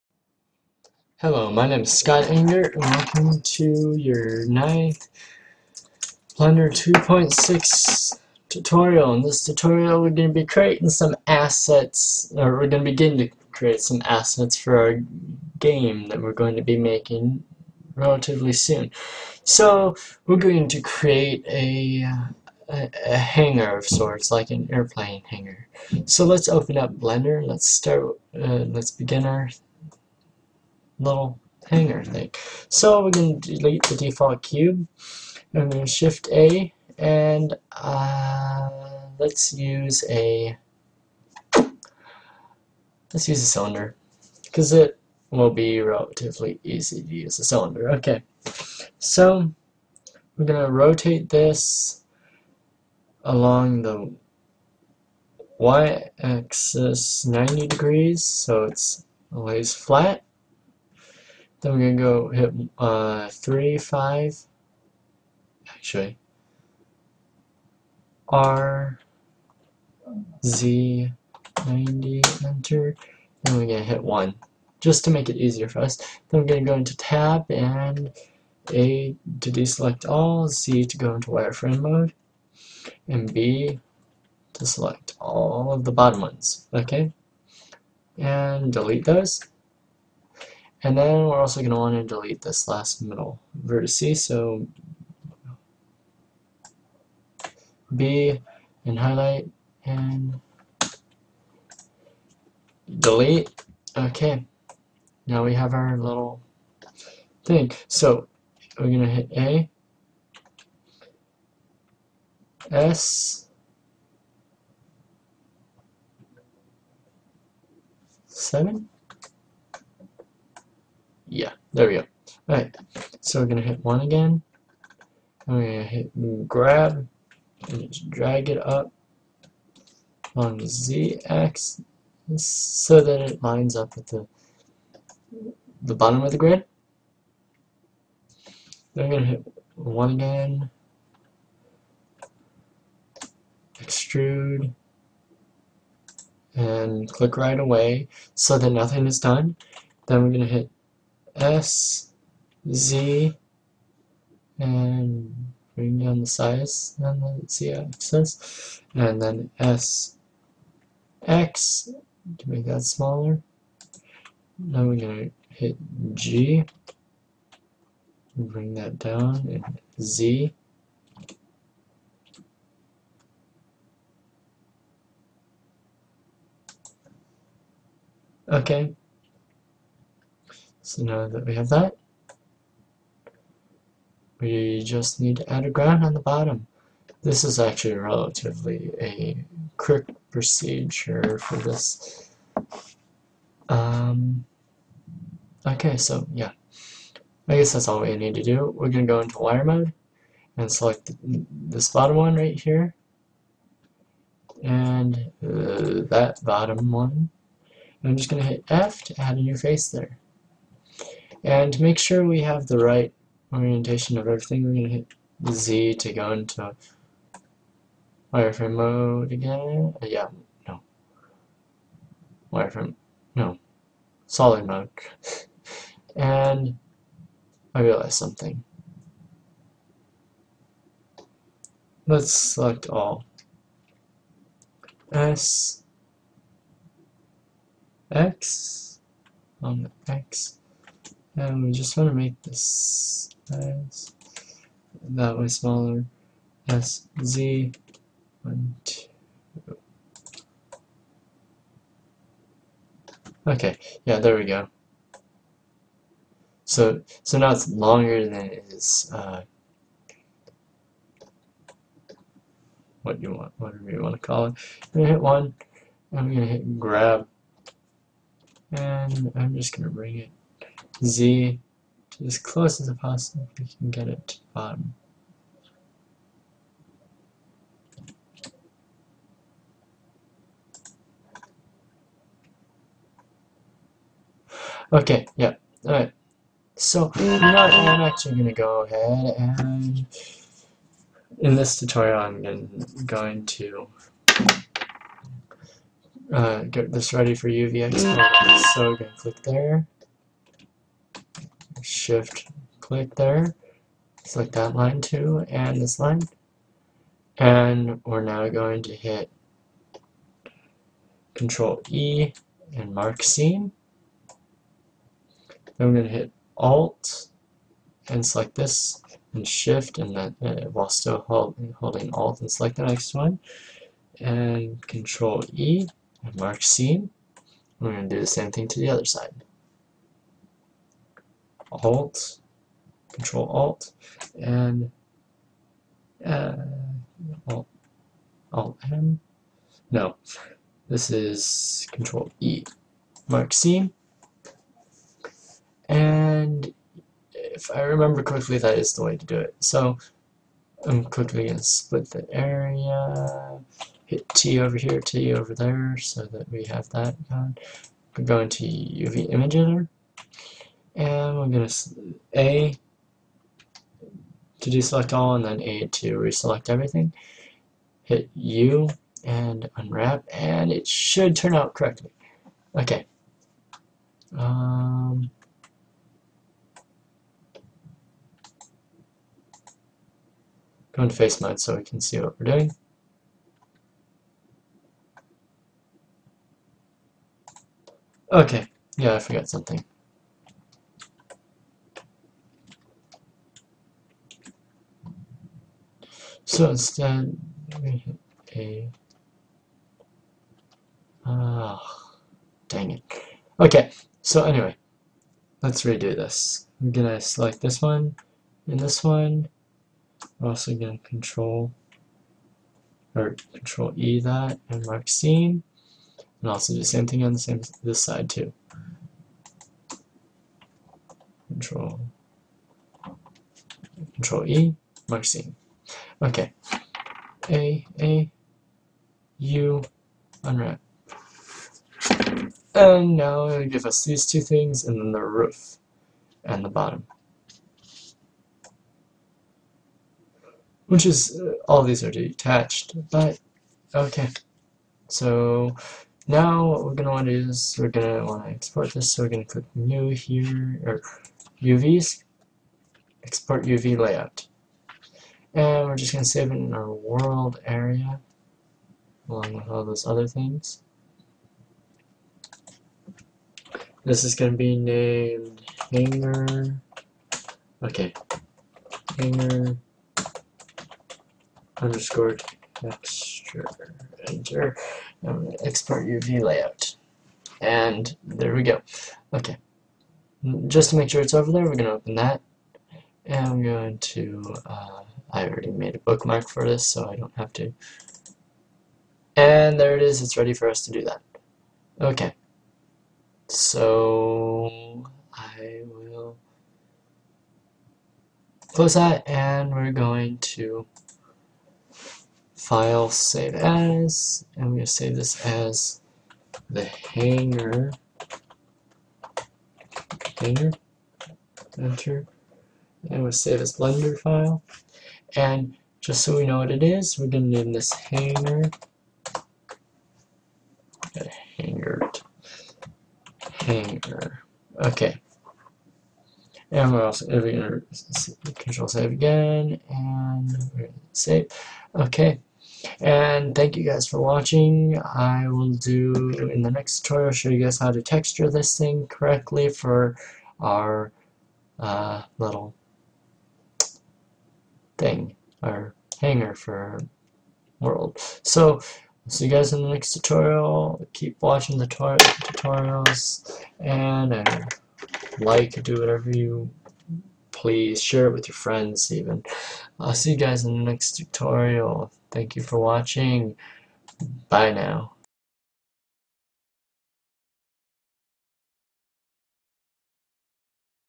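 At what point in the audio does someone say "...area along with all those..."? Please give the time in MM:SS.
07:37.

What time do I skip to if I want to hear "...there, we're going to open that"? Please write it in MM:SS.
08:01.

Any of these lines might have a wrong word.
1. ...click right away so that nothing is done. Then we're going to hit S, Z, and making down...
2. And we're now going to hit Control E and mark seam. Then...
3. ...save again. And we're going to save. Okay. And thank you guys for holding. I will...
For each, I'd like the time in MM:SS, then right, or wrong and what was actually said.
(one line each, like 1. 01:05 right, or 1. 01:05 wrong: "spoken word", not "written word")
1. 02:27 wrong: "bring", not "making"
2. 05:07 right
3. 08:48 wrong: "watching", not "holding".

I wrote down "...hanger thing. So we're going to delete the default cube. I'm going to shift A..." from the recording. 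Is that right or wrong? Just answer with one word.
right.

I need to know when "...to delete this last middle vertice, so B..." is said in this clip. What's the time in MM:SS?
01:31.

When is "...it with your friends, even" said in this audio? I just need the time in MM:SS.
09:18.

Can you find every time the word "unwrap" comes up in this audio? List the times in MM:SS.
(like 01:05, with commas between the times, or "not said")
06:09, 07:10.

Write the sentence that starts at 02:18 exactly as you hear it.
Then I'm going to hit 1 again.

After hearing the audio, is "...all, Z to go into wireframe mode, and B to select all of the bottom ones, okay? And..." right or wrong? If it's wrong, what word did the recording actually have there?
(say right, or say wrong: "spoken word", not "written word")
right.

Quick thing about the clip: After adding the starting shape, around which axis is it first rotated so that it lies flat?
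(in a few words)
y-axis.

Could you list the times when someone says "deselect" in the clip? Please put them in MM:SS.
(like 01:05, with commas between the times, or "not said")
01:19, 06:04.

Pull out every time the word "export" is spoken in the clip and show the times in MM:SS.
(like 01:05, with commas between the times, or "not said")
07:28, 07:33, 07:55.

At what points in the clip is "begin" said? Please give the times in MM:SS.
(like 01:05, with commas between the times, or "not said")
00:12, 00:28.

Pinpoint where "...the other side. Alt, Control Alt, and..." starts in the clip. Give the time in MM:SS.
05:28.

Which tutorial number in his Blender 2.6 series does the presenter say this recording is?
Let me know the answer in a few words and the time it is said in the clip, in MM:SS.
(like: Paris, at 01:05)
9th, at 00:04.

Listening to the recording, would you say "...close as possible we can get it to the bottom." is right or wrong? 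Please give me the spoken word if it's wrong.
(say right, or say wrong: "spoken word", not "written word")
right.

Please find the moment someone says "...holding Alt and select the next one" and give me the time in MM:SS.
05:21.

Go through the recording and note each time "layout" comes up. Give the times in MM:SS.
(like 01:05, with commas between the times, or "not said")
07:33, 07:56.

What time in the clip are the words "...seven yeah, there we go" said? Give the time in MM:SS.
01:58.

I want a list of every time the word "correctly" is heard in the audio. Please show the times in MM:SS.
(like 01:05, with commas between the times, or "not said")
05:48, 06:11, 08:59.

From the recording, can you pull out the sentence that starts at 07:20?
Which is, uh, all these are detached, but, okay.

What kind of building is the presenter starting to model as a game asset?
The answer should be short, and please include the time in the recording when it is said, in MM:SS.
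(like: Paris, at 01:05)
airplane hanger, at 00:24.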